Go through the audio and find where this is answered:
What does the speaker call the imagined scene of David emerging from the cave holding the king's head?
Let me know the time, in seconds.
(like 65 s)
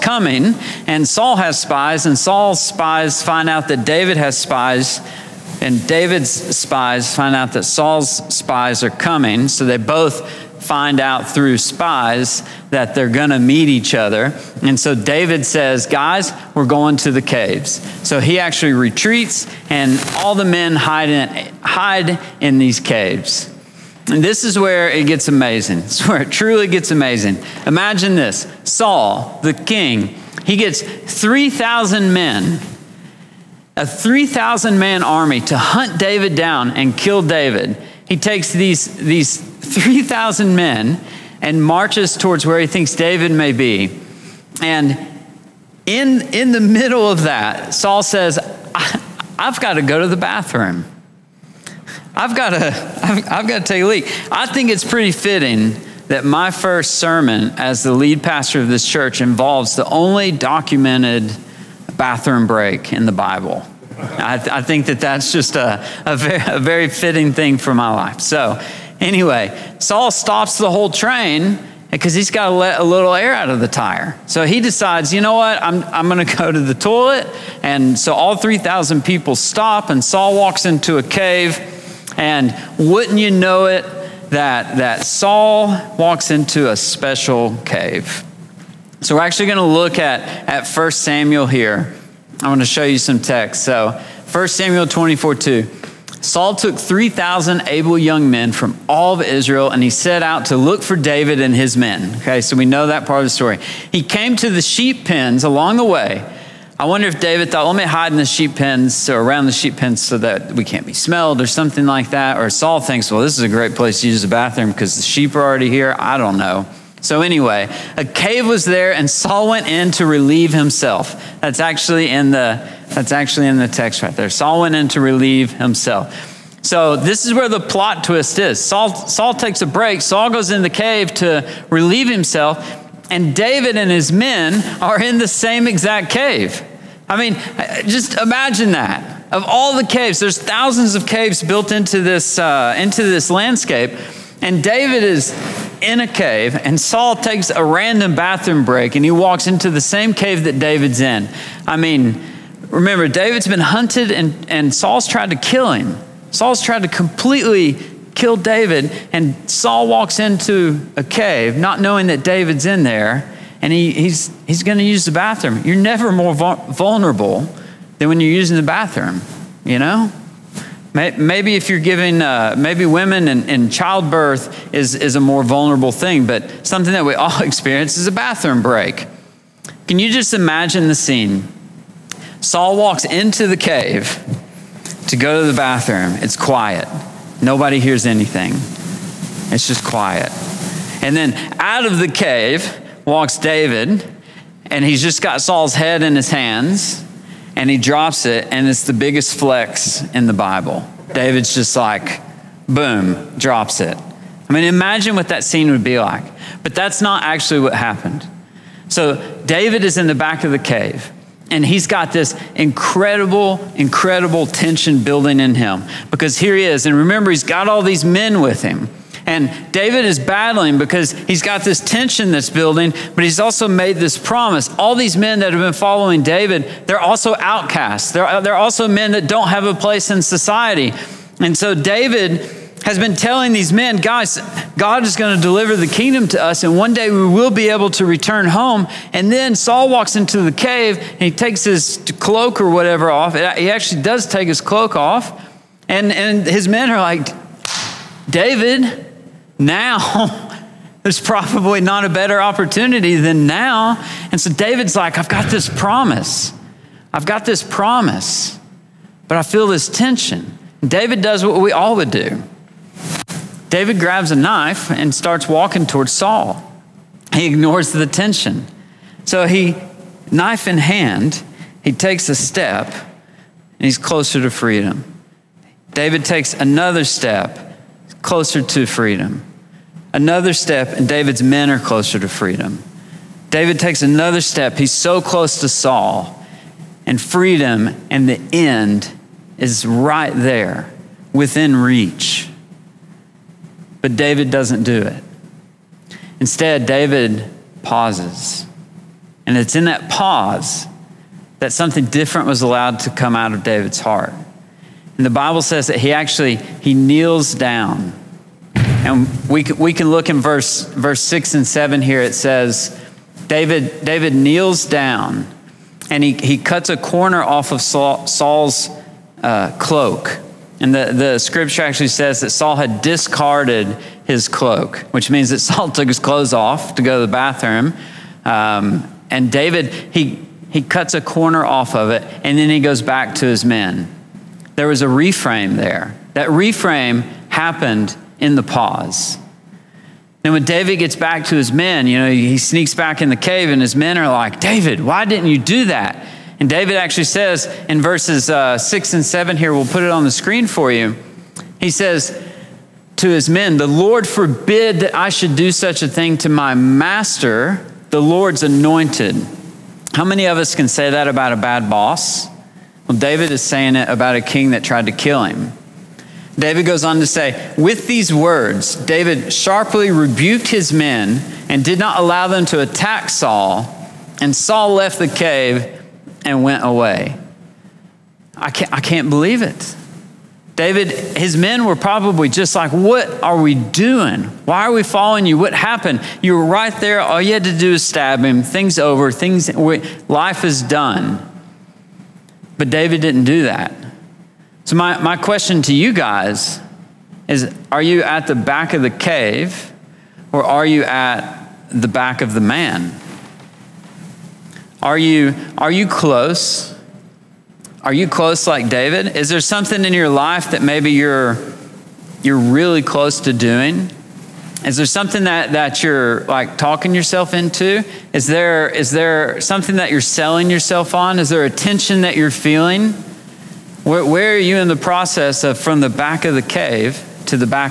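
198 s.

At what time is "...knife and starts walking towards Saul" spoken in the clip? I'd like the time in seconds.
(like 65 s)
264 s.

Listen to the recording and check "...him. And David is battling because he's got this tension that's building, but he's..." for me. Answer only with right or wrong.
right.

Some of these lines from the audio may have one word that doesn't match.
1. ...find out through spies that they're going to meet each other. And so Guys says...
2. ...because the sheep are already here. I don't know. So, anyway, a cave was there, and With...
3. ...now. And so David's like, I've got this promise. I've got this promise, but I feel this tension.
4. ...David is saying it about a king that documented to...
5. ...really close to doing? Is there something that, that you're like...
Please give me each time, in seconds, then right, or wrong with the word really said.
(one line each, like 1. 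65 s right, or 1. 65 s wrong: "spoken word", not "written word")
1. 10 s wrong: "David", not "Guys"
2. 114 s wrong: "Saul", not "With"
3. 253 s right
4. 363 s wrong: "tried", not "documented"
5. 412 s right.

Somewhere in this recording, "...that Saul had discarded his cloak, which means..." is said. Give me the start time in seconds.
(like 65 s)
322 s.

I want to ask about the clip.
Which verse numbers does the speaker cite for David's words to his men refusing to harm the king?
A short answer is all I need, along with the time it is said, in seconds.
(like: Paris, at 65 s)
6 and 7, at 348 s.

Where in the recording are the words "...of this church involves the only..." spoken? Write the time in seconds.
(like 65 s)
58 s.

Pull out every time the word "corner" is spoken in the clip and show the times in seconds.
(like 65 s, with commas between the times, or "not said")
316 s, 331 s.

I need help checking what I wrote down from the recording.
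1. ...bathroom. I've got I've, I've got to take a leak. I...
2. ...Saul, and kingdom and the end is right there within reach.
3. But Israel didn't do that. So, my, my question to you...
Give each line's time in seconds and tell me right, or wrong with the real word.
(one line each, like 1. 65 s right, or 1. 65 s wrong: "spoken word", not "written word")
1. 50 s right
2. 285 s wrong: "freedom", not "kingdom"
3. 392 s wrong: "David", not "Israel".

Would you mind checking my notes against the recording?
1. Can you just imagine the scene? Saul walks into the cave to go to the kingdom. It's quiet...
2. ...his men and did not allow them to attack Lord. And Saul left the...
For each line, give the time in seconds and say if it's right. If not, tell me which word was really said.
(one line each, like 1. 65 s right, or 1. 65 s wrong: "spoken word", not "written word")
1. 179 s wrong: "bathroom", not "kingdom"
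2. 370 s wrong: "Saul", not "Lord".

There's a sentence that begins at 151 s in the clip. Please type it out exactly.
I mean, remember, David's been hunted and, and Saul's tried to kill him.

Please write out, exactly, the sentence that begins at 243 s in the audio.
He actually does take his cloak off.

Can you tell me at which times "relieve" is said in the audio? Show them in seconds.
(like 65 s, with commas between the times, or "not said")
120 s, 125 s, 131 s.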